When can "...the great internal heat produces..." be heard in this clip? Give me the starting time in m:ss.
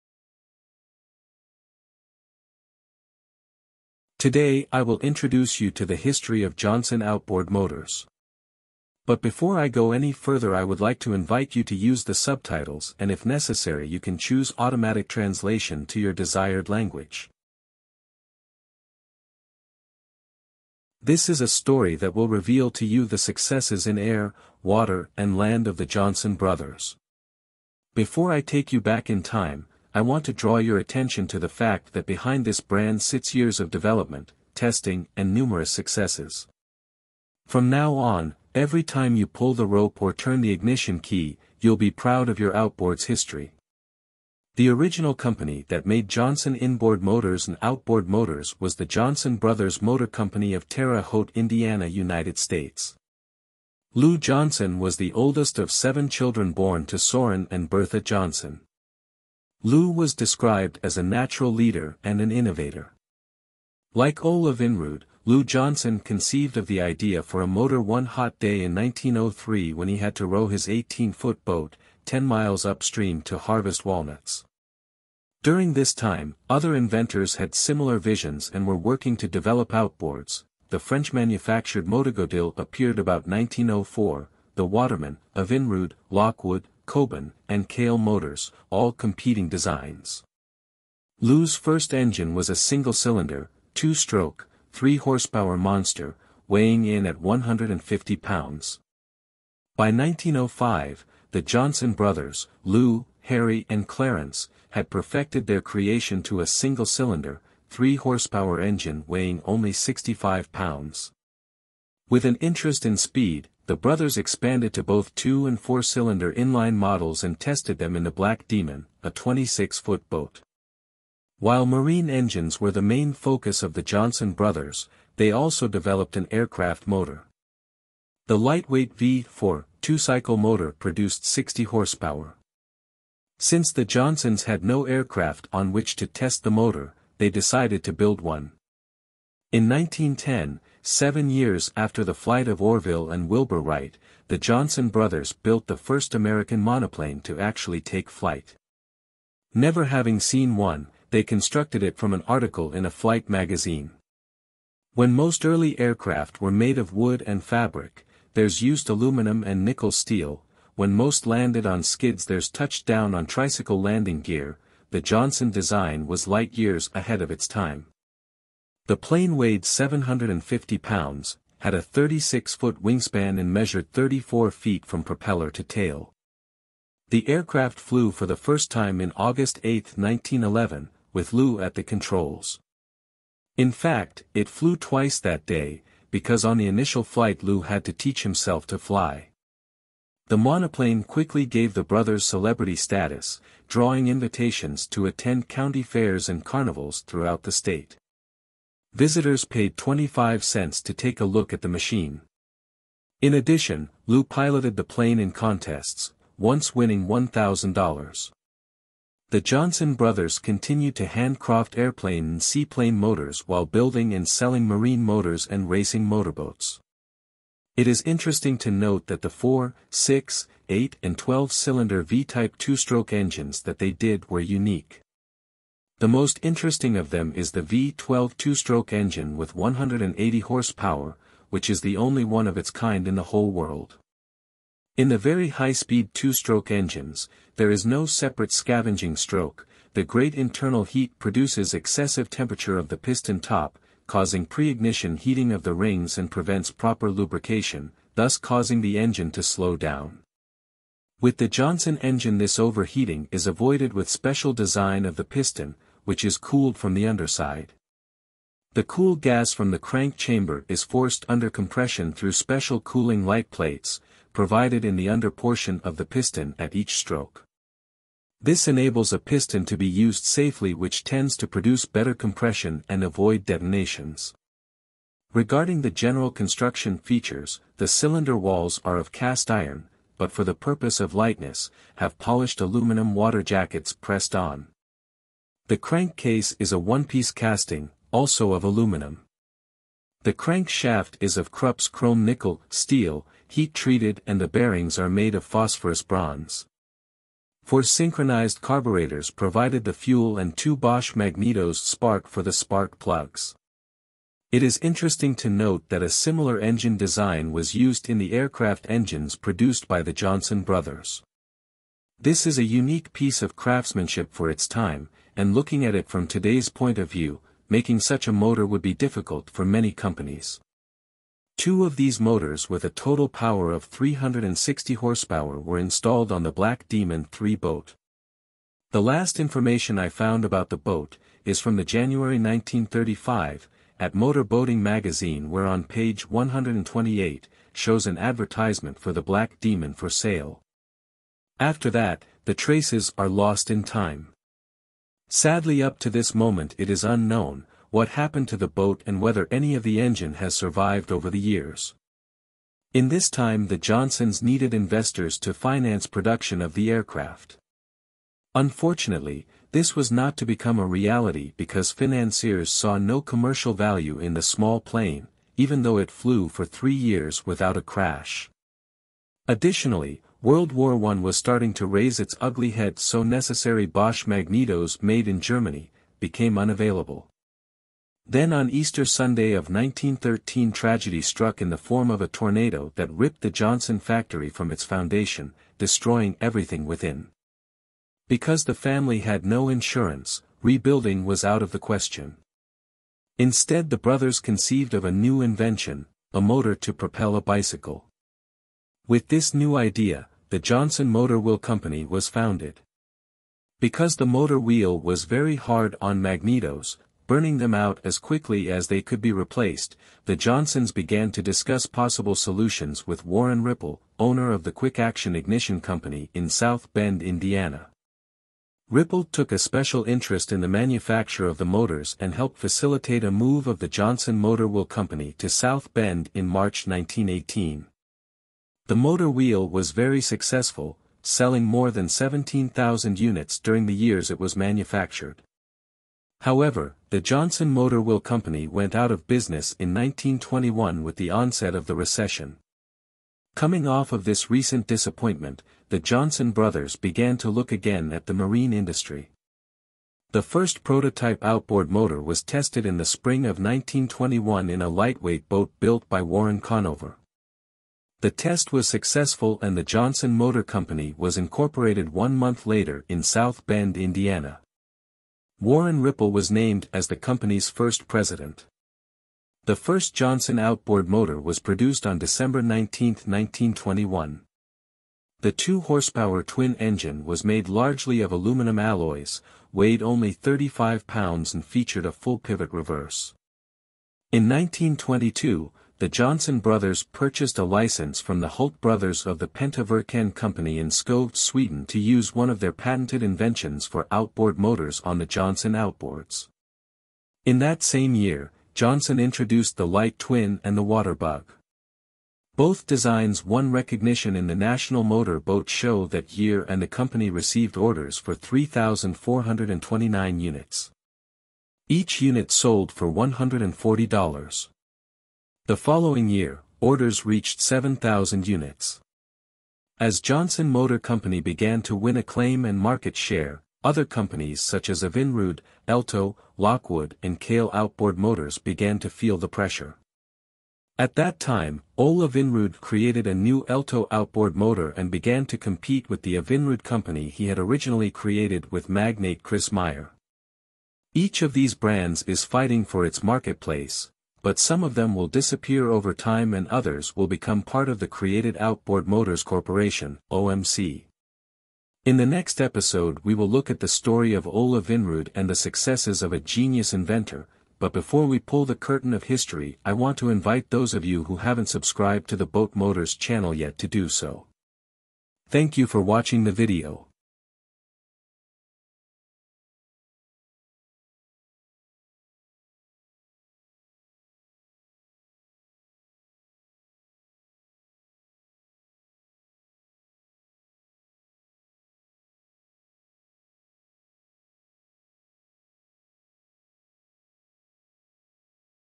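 3:59.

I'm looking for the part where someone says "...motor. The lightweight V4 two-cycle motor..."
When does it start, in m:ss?
2:06.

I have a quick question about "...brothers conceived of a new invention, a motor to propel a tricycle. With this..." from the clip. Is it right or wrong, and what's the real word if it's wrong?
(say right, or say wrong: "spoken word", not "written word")
wrong: "bicycle", not "tricycle".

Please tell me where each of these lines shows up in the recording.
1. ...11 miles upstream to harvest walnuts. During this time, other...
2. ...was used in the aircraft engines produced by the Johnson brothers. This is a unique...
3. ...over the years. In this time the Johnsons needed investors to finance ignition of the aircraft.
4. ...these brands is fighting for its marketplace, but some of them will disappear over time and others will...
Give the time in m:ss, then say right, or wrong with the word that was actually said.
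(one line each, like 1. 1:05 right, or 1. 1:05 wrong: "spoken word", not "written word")
1. 1:12 wrong: "10", not "11"
2. 5:07 right
3. 5:51 wrong: "production", not "ignition"
4. 9:01 right.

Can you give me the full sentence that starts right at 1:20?
The French-manufactured Motogodille appeared about 1904, the Waterman, Evinrude, Lockwood, Koban, and Caille motors, all competing designs.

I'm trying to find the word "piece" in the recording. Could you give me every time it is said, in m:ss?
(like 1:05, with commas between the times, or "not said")
4:46, 5:13.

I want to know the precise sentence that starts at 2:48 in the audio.
The plane weighed 750 pounds, had a 36-foot wingspan and measured 34 feet from propeller to tail.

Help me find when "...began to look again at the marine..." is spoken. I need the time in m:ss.
7:26.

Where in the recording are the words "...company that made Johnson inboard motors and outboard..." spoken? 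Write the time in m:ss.
0:45.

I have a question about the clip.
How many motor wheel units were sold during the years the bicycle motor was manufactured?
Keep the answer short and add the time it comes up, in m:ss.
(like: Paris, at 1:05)
17,000, at 7:12.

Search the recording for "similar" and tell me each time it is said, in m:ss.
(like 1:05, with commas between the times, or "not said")
1:17, 5:06.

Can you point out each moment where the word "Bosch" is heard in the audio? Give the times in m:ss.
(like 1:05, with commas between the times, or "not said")
5:00, 6:13.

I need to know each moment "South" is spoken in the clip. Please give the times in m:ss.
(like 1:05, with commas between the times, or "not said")
6:56, 7:05, 7:43.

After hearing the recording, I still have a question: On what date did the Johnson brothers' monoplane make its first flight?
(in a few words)
August 8, 1911.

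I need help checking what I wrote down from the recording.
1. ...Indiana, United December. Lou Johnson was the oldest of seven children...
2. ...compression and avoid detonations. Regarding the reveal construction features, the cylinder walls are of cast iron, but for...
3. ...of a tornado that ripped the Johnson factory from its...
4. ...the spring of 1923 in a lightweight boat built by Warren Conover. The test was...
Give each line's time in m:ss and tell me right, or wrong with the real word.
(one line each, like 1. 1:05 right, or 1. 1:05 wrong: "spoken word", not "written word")
1. 0:51 wrong: "States", not "December"
2. 4:32 wrong: "general", not "reveal"
3. 6:22 right
4. 7:32 wrong: "1921", not "1923".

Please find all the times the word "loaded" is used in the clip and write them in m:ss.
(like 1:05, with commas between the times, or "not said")
not said.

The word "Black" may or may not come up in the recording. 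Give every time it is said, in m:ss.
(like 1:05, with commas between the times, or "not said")
1:58, 5:26, 5:39.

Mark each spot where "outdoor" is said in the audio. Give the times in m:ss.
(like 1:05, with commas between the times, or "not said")
not said.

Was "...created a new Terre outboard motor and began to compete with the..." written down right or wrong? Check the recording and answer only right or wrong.
wrong.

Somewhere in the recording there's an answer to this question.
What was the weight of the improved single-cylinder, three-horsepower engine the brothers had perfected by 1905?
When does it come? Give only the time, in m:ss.
1:49.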